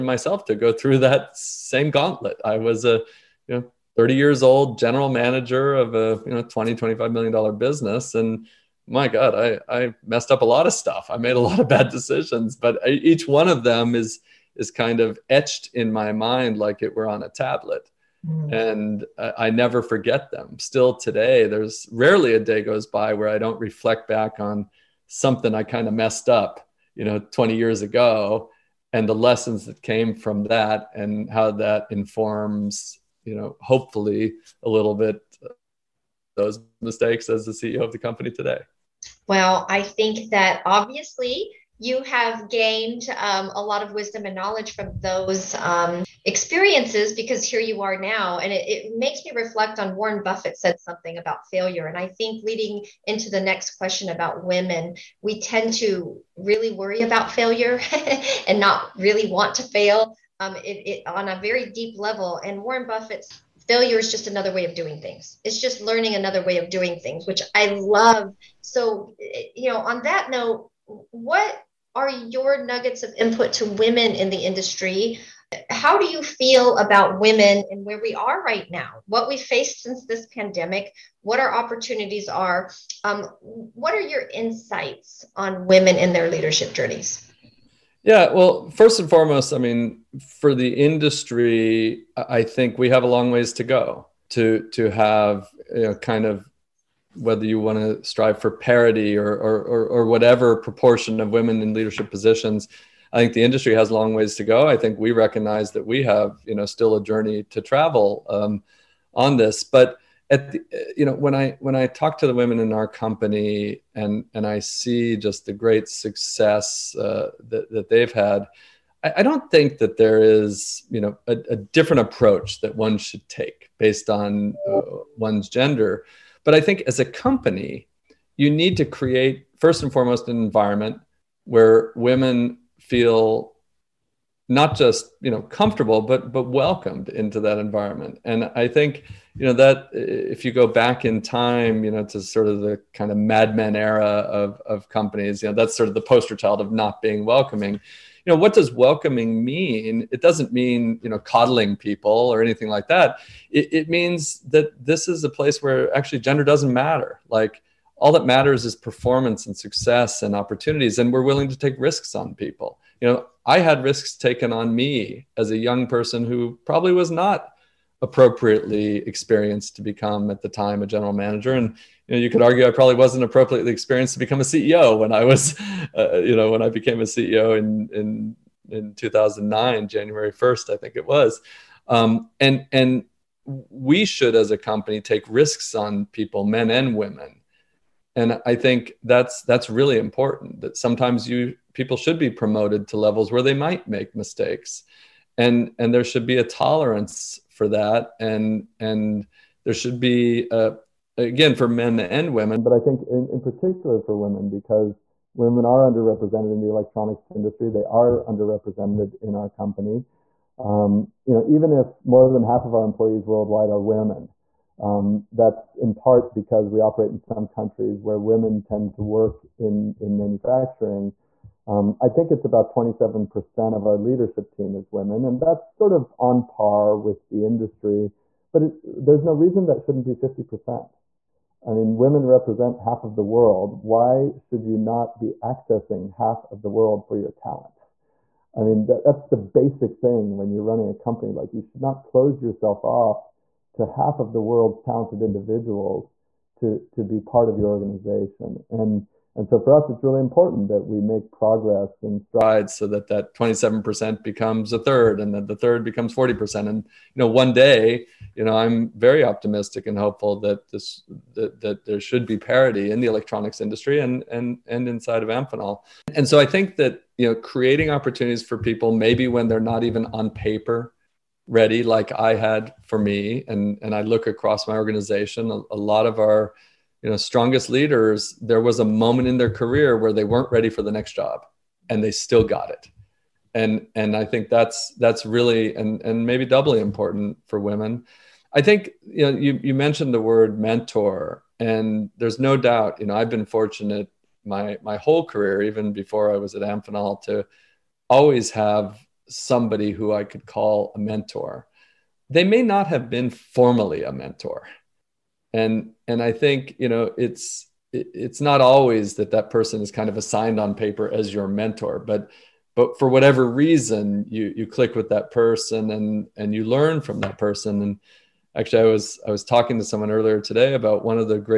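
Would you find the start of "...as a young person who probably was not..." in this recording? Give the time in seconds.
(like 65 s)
165 s.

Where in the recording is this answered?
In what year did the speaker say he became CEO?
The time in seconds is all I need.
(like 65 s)
178 s.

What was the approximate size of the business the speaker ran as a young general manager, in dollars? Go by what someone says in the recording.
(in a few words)
$20-25 million.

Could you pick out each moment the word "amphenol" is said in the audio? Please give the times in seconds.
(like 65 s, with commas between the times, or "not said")
265 s, 296 s.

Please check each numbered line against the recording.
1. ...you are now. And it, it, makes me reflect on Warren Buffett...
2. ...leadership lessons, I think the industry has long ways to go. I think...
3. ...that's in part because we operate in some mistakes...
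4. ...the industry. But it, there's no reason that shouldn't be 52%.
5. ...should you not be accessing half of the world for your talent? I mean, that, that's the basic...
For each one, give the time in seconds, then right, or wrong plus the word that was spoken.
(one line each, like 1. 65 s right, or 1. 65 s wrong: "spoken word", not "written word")
1. 47 s right
2. 101 s wrong: "positions", not "lessons"
3. 215 s wrong: "countries", not "mistakes"
4. 227 s wrong: "50", not "52"
5. 234 s right.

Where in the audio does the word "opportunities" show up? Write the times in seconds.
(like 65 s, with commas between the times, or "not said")
81 s, 160 s, 267 s.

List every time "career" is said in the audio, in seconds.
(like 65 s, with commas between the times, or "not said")
279 s, 295 s.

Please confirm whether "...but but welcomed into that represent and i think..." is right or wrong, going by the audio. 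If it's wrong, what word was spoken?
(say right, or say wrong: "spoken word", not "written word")
wrong: "environment", not "represent".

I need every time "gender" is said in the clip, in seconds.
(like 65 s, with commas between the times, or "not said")
125 s, 156 s.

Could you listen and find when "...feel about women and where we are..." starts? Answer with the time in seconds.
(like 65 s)
76 s.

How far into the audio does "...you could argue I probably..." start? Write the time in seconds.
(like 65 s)
172 s.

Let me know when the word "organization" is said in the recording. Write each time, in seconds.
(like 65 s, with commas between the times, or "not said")
247 s, 274 s.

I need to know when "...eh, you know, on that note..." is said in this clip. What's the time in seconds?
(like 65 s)
69 s.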